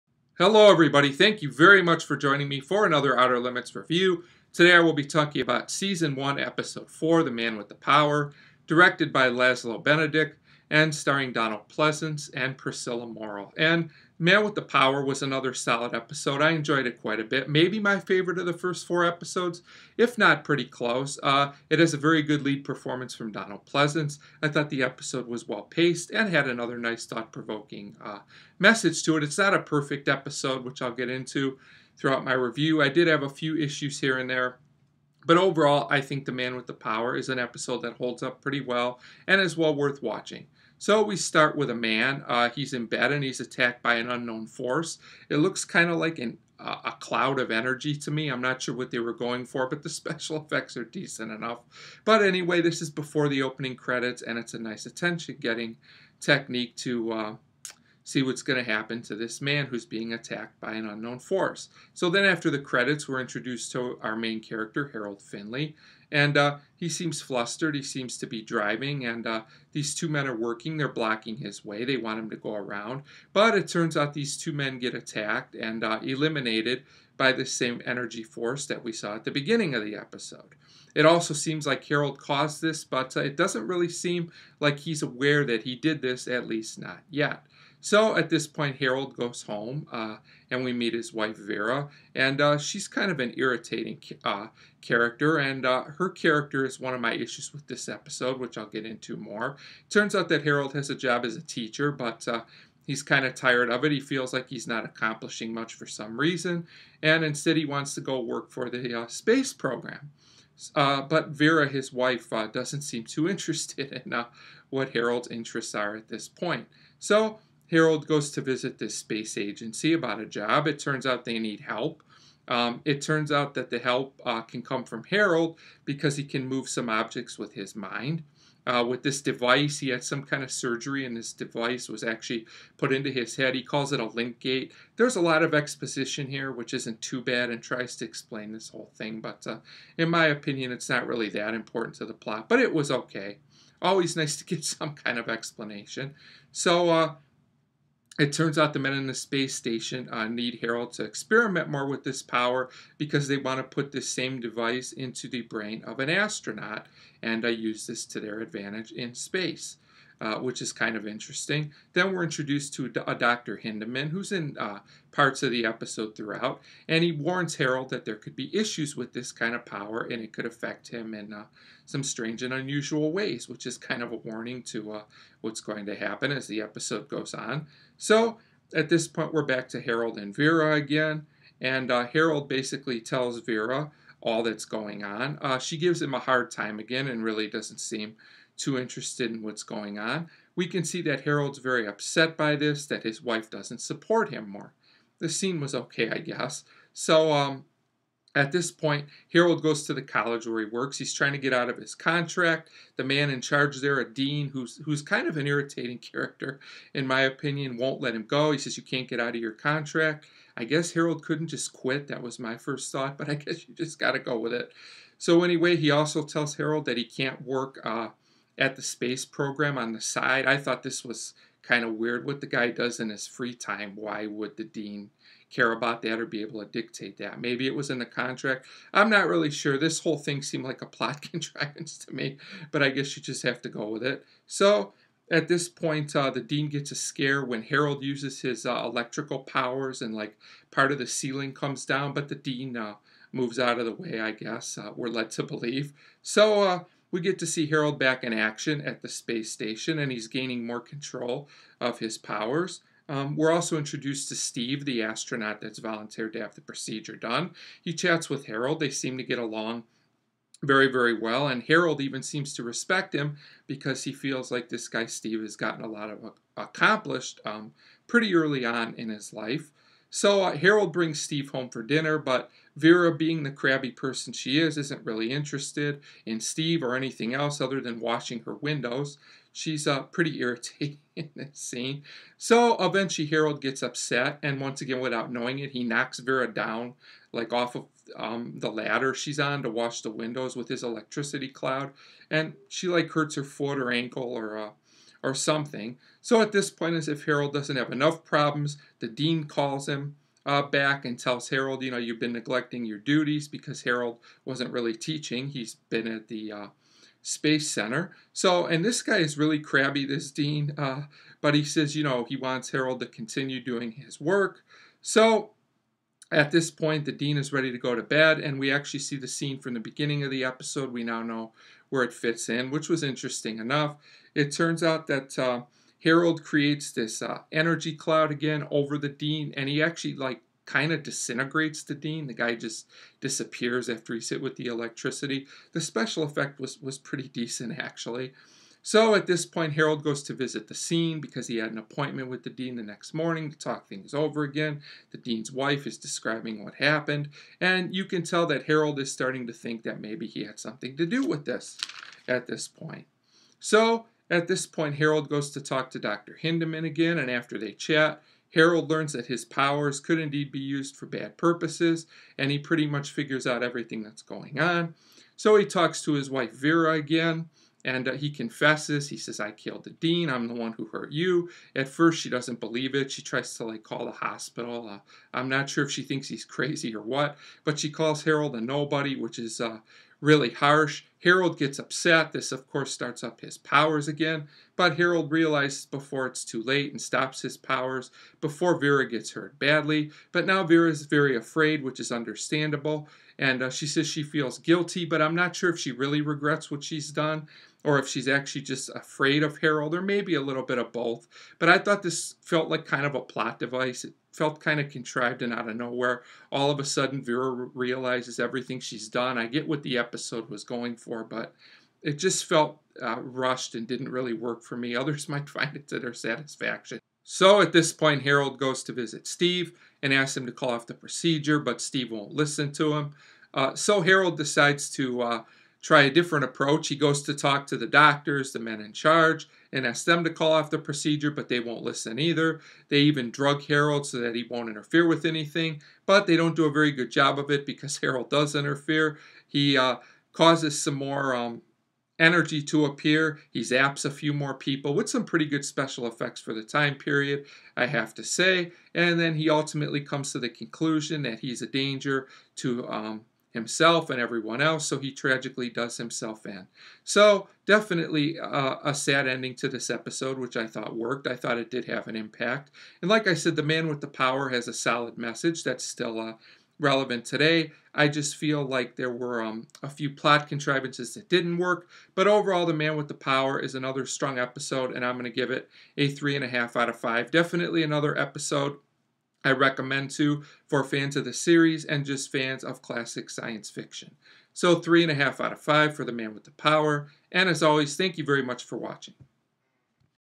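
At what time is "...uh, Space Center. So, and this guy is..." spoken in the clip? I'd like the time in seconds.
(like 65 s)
306 s.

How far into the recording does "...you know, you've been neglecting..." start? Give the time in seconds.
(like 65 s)
301 s.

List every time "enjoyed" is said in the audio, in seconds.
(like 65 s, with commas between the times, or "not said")
16 s.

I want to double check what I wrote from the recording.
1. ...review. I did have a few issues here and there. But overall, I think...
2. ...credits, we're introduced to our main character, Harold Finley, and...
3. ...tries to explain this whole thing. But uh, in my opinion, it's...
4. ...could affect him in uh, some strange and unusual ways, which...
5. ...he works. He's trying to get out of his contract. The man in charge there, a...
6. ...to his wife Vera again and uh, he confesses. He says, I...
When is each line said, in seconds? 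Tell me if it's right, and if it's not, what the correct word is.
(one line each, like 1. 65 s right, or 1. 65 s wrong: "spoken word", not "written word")
1. 32 s right
2. 62 s right
3. 137 s right
4. 170 s right
5. 200 s right
6. 366 s right.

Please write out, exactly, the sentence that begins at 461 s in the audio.
I thought it did have an impact.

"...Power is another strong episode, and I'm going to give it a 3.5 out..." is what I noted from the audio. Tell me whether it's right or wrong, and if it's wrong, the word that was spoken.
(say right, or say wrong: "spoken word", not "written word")
right.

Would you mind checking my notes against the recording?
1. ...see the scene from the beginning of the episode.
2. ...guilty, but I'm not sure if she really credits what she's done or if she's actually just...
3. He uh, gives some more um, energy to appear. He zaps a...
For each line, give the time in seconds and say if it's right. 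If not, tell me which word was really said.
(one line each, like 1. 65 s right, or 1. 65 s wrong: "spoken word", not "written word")
1. 319 s right
2. 394 s wrong: "regrets", not "credits"
3. 439 s wrong: "causes", not "gives".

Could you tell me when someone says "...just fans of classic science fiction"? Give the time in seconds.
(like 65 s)
482 s.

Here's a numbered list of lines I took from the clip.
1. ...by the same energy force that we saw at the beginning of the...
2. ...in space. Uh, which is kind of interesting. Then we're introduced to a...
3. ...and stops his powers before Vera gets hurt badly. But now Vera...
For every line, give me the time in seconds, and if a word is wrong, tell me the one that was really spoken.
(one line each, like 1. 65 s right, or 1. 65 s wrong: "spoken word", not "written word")
1. 77 s right
2. 158 s right
3. 386 s right.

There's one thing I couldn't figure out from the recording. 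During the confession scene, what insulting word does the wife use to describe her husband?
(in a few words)
a nobody.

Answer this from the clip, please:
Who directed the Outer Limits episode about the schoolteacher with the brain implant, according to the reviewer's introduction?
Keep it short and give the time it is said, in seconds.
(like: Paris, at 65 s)
Laslo Benedek, at 9 s.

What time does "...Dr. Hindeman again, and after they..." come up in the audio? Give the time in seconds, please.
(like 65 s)
355 s.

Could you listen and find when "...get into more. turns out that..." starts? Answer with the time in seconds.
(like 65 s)
98 s.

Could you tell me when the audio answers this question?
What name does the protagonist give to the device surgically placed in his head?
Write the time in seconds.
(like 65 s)
134 s.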